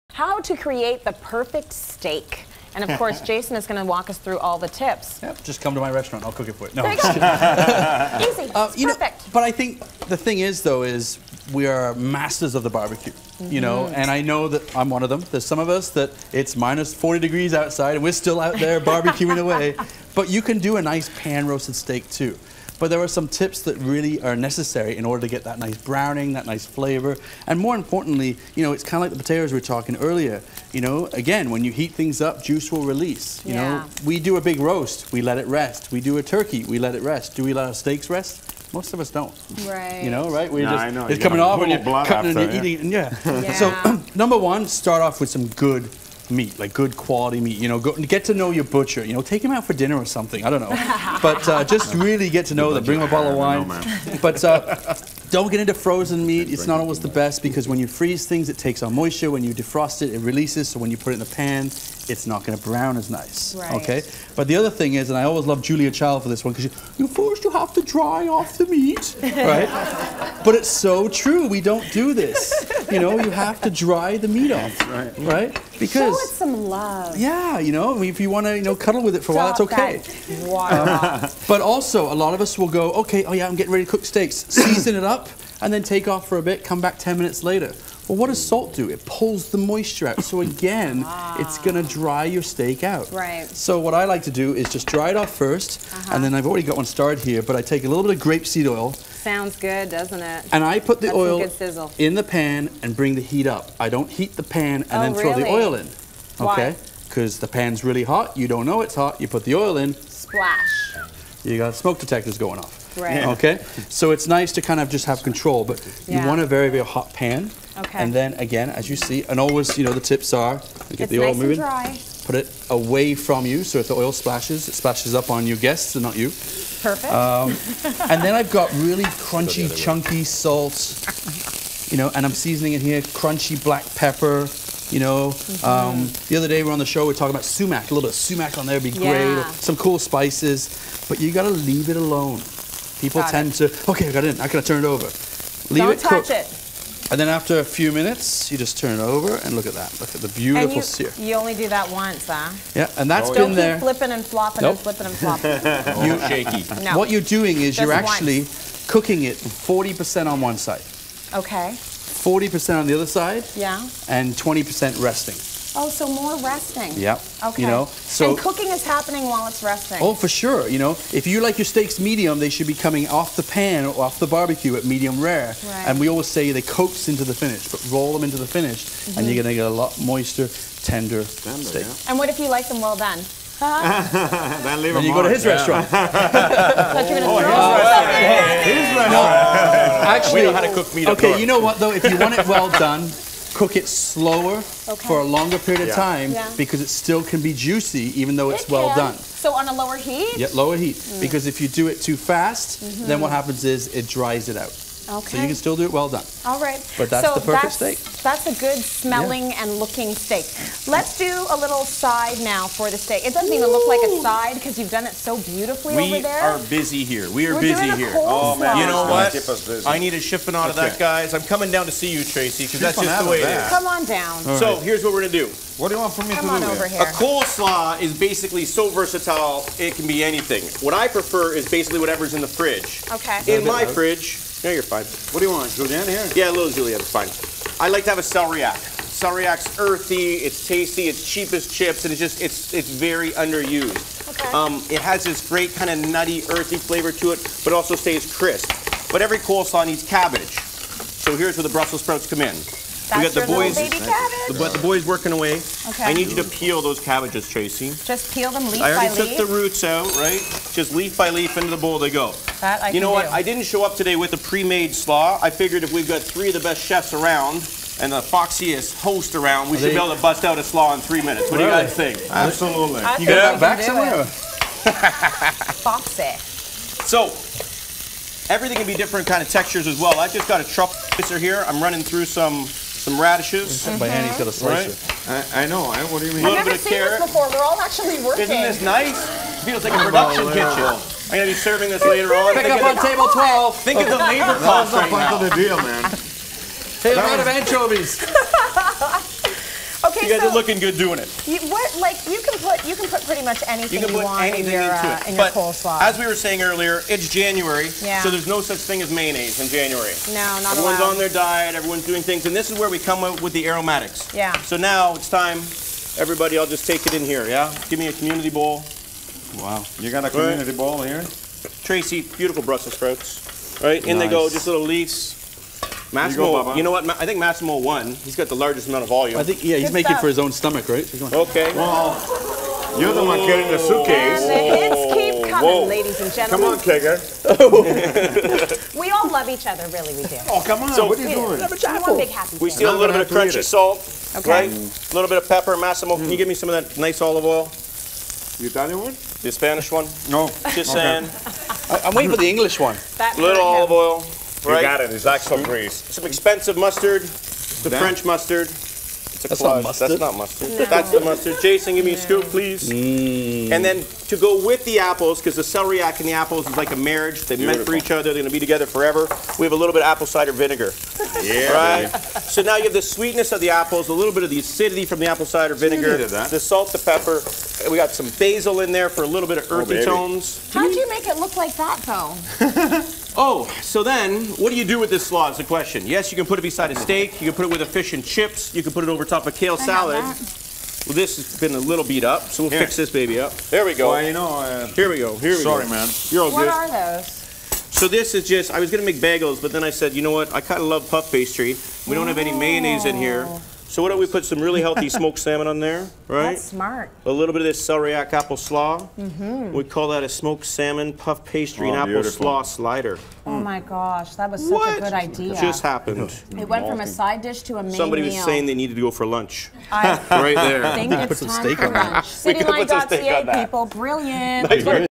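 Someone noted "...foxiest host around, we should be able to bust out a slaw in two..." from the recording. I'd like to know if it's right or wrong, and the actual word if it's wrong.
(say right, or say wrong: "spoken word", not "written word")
wrong: "three", not "two".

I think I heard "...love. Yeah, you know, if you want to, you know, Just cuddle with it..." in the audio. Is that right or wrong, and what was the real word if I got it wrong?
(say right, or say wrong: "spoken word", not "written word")
right.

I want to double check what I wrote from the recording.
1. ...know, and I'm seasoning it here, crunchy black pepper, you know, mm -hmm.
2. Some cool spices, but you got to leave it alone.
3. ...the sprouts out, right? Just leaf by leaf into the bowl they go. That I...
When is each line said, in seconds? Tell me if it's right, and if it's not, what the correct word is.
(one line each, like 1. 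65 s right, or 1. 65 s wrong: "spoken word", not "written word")
1. 131 s right
2. 139 s right
3. 259 s wrong: "roots", not "sprouts".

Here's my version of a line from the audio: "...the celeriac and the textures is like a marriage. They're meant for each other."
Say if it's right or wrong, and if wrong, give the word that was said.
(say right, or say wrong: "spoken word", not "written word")
wrong: "apples", not "textures".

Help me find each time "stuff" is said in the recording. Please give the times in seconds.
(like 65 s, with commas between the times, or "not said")
330 s.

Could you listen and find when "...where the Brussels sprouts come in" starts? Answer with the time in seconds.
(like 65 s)
251 s.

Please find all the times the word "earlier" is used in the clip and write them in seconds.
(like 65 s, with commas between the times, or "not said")
29 s, 306 s.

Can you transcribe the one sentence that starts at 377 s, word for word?
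We got some basil in there for a little bit of oh, earthy oh, tones.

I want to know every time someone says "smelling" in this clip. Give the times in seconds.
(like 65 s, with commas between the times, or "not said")
208 s.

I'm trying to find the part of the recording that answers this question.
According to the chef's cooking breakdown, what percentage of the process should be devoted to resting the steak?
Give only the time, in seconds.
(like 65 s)
164 s.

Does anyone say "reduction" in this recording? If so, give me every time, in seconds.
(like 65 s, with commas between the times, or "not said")
not said.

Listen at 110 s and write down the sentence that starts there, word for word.
Splash you got smoke detectors going off.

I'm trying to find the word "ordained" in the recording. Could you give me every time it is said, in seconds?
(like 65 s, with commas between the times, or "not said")
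not said.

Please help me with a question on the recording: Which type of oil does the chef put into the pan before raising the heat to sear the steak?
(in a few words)
grapeseed oil.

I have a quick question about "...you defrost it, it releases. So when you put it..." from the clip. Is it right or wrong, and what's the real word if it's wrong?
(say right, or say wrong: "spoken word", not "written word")
right.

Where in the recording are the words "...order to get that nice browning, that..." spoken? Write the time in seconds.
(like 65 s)
25 s.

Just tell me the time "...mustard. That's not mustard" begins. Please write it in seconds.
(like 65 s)
359 s.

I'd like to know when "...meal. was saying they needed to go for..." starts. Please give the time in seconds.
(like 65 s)
418 s.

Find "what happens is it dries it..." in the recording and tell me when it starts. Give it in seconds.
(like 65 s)
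203 s.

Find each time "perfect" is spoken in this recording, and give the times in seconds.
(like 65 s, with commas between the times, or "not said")
1 s, 8 s, 126 s, 207 s.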